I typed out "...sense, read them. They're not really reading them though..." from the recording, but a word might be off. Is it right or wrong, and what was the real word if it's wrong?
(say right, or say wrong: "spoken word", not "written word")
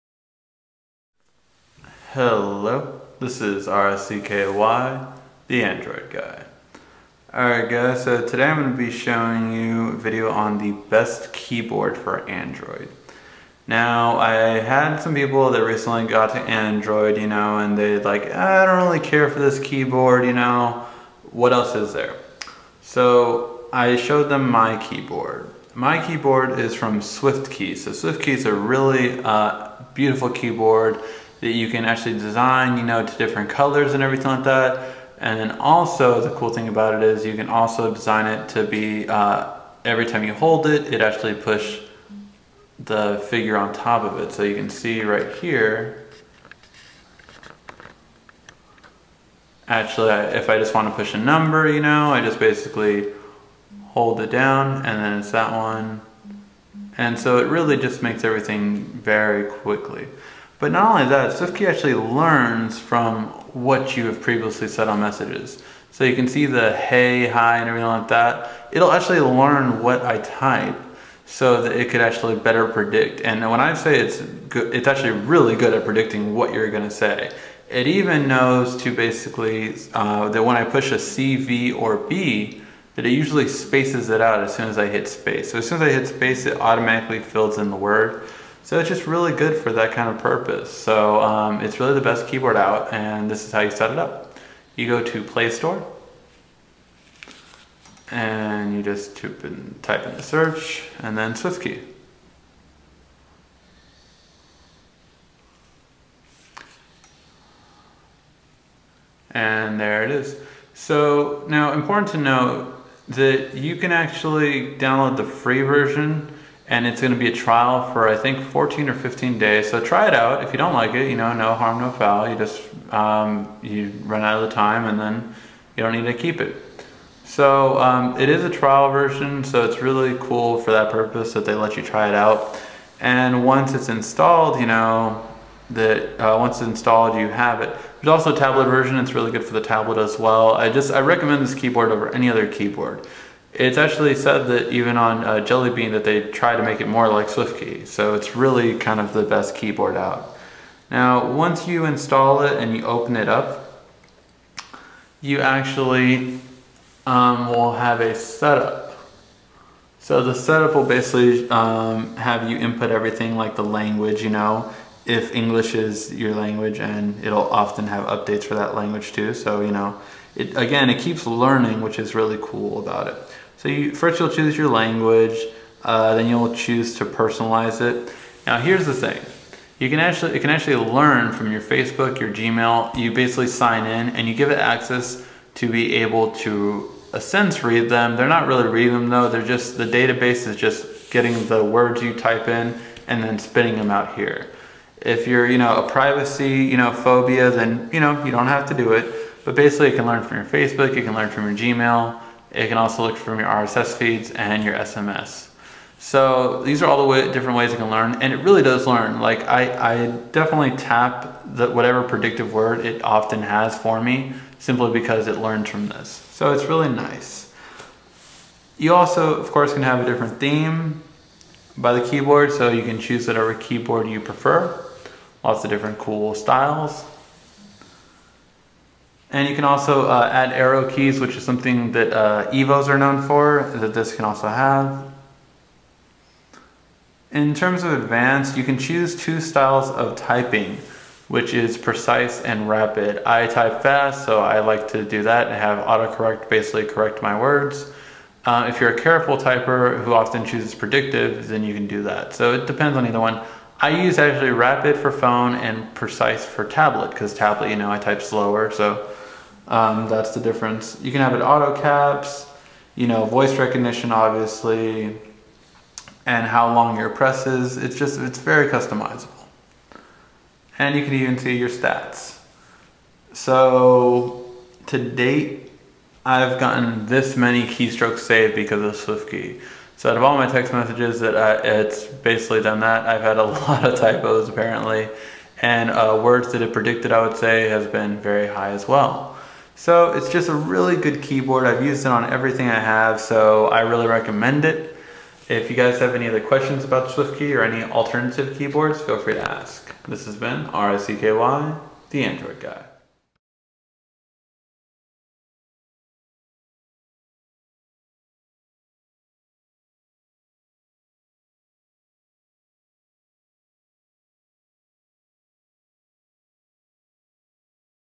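right.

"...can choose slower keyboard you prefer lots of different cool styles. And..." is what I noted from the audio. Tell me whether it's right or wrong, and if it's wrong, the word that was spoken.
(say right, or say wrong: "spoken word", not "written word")
wrong: "whatever", not "slower".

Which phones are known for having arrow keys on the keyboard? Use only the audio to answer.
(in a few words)
Evos.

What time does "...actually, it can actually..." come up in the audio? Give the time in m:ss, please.
2:59.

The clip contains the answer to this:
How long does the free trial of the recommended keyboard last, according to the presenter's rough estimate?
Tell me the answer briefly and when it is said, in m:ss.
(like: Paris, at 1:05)
14 or 15 days, at 1:58.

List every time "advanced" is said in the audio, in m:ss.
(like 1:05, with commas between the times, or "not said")
3:57.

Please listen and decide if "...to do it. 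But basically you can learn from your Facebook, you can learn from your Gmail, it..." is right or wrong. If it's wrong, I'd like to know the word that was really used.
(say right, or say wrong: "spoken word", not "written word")
right.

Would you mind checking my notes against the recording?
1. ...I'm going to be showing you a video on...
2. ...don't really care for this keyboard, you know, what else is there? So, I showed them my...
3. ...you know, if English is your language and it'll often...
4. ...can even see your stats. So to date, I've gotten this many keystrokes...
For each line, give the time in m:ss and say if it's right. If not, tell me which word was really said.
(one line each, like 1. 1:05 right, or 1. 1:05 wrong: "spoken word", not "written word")
1. 0:08 right
2. 0:18 right
3. 2:44 right
4. 4:31 right.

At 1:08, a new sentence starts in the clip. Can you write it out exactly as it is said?
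It'll actually learn what I type so that it could actually better predict.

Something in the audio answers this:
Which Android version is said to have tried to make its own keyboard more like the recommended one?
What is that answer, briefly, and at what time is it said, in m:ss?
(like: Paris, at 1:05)
Jelly Bean, at 2:25.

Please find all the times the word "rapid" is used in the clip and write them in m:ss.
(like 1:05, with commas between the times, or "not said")
4:02, 4:14.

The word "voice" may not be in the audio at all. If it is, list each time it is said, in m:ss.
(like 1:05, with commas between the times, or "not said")
4:23.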